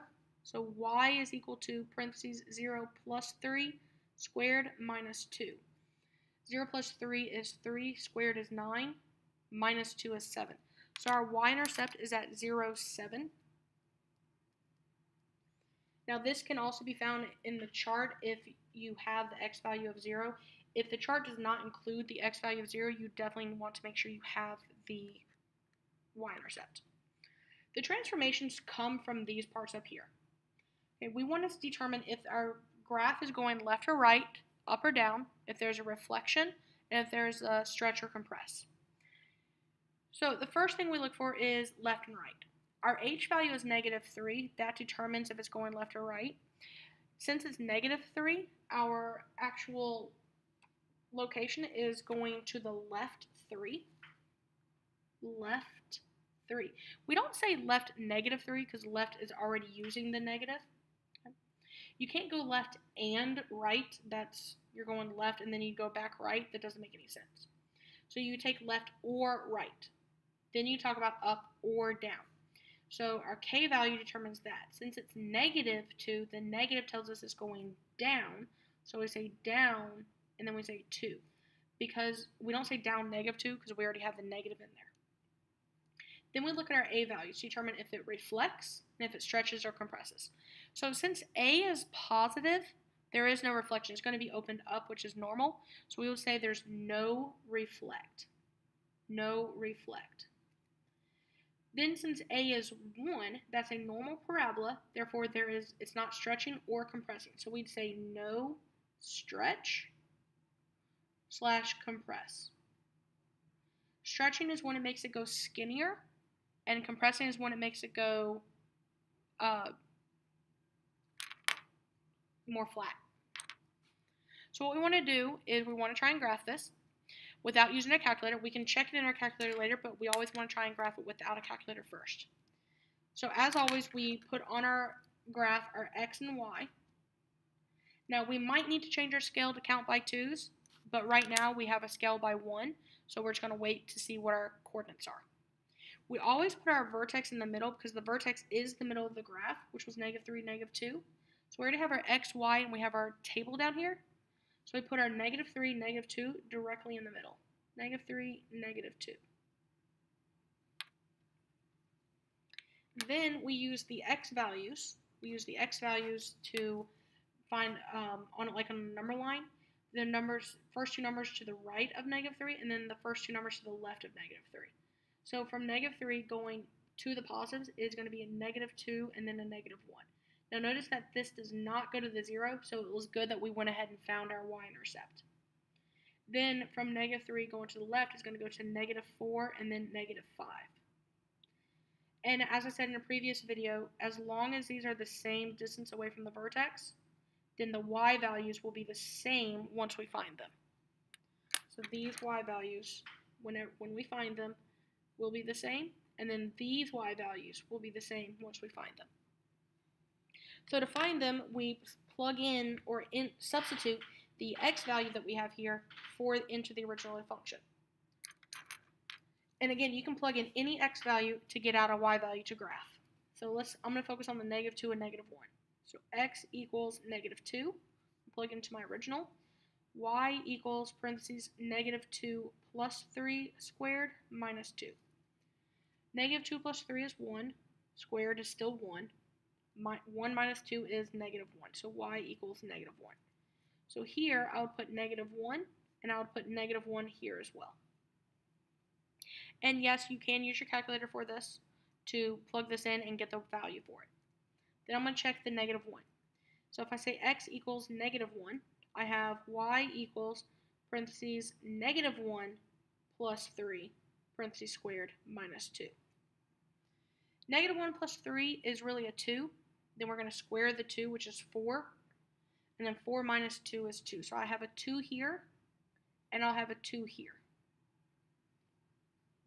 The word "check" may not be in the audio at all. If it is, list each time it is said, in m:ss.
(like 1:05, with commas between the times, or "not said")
2:08, 4:15.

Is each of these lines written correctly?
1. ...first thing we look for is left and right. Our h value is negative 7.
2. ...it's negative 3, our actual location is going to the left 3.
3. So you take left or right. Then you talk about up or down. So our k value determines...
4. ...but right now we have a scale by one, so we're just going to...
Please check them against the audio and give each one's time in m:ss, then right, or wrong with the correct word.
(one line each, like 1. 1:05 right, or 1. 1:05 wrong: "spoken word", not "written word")
1. 0:40 wrong: "3", not "7"
2. 0:47 right
3. 1:08 right
4. 2:20 right.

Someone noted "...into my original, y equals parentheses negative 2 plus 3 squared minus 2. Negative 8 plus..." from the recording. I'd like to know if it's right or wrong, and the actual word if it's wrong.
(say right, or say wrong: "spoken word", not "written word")
wrong: "2", not "8".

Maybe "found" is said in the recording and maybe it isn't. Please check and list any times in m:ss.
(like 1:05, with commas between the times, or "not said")
0:16, 3:04.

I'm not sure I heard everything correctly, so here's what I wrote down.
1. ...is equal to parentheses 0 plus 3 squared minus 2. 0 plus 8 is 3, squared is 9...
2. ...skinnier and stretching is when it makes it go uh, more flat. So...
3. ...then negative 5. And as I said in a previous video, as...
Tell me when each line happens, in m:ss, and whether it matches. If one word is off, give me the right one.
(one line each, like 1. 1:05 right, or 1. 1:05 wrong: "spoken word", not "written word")
1. 0:01 wrong: "3", not "8"
2. 1:55 wrong: "compressing", not "stretching"
3. 3:09 right.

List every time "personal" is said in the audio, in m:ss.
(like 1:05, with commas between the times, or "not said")
not said.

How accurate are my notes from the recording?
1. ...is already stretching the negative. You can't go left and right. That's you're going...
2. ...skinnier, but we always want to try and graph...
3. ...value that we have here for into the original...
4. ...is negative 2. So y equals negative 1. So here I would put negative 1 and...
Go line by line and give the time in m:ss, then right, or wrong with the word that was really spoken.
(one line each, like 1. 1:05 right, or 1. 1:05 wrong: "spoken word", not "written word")
1. 0:59 wrong: "using", not "stretching"
2. 2:09 wrong: "later", not "skinnier"
3. 3:34 right
4. 4:00 wrong: "1", not "2".